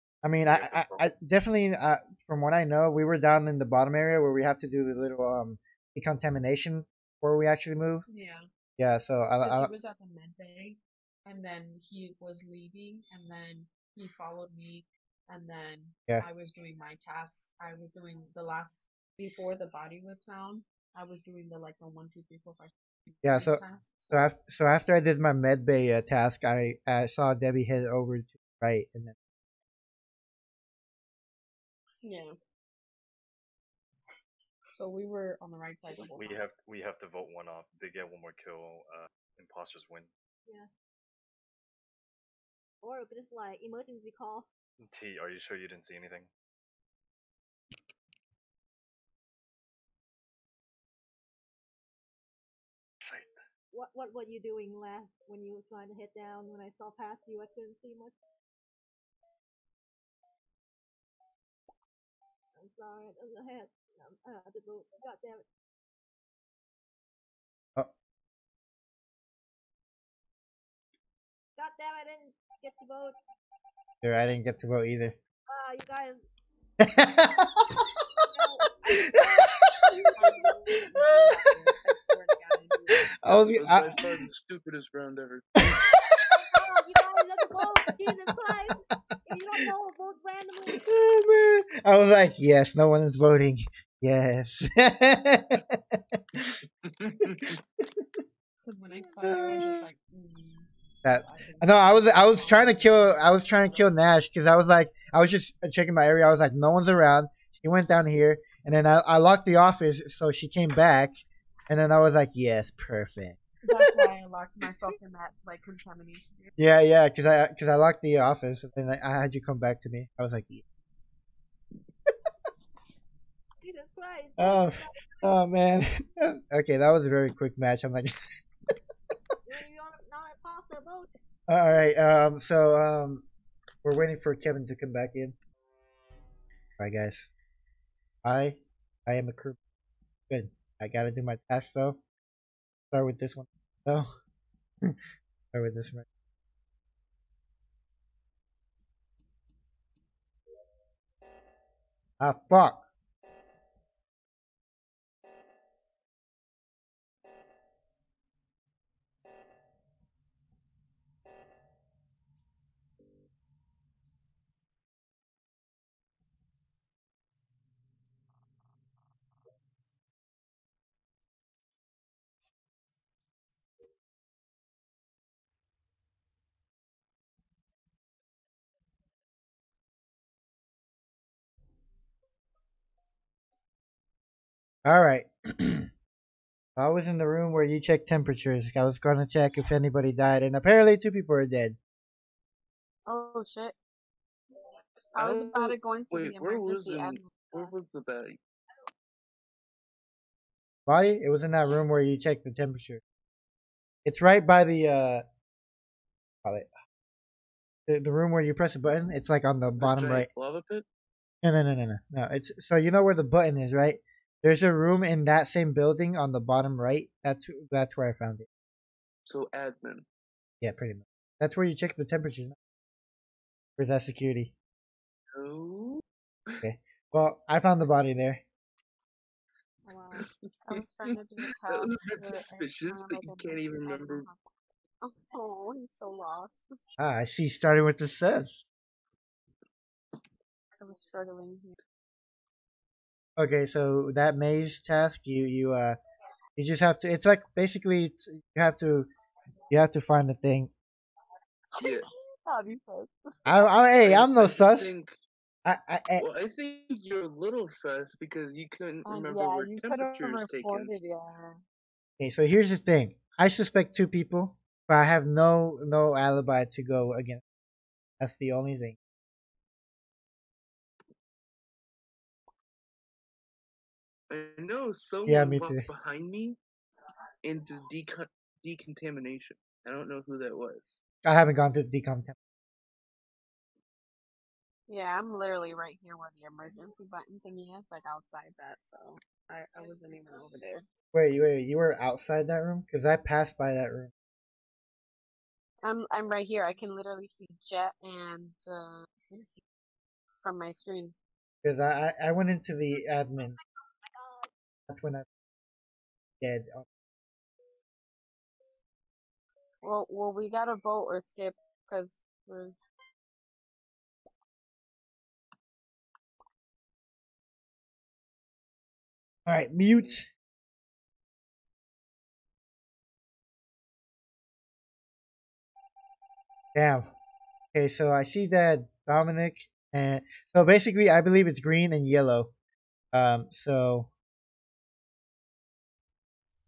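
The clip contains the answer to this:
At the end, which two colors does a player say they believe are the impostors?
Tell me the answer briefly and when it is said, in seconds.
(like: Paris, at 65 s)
Green and yellow, at 331 s.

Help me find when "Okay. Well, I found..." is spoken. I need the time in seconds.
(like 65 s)
226 s.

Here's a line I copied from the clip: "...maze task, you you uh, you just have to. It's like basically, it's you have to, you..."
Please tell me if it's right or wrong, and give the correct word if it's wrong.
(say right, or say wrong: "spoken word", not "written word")
right.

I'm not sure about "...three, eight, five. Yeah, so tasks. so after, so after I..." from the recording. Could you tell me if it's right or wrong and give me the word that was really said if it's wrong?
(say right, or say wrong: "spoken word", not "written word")
wrong: "four", not "eight".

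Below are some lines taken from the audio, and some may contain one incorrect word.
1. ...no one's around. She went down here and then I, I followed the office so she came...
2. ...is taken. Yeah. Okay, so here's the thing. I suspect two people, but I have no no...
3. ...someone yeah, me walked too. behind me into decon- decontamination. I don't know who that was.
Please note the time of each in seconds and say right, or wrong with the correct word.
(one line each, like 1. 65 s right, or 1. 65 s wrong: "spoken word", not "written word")
1. 106 s wrong: "locked", not "followed"
2. 260 s right
3. 274 s right.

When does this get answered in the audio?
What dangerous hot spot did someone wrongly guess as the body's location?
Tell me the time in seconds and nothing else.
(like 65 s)
210 s.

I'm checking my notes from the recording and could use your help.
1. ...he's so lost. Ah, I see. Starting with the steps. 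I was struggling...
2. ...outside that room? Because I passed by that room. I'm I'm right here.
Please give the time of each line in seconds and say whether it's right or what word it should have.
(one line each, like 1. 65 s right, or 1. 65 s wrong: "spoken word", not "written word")
1. 235 s right
2. 292 s right.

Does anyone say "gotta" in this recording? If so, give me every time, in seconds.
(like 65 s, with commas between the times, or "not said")
140 s, 310 s.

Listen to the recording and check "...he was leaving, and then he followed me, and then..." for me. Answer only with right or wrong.
right.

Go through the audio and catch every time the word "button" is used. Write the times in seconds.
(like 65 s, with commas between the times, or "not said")
208 s, 213 s, 287 s.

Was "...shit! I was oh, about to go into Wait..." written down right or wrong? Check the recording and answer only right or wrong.
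right.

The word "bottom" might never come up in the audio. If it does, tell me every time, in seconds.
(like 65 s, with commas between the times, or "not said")
3 s, 209 s, 216 s.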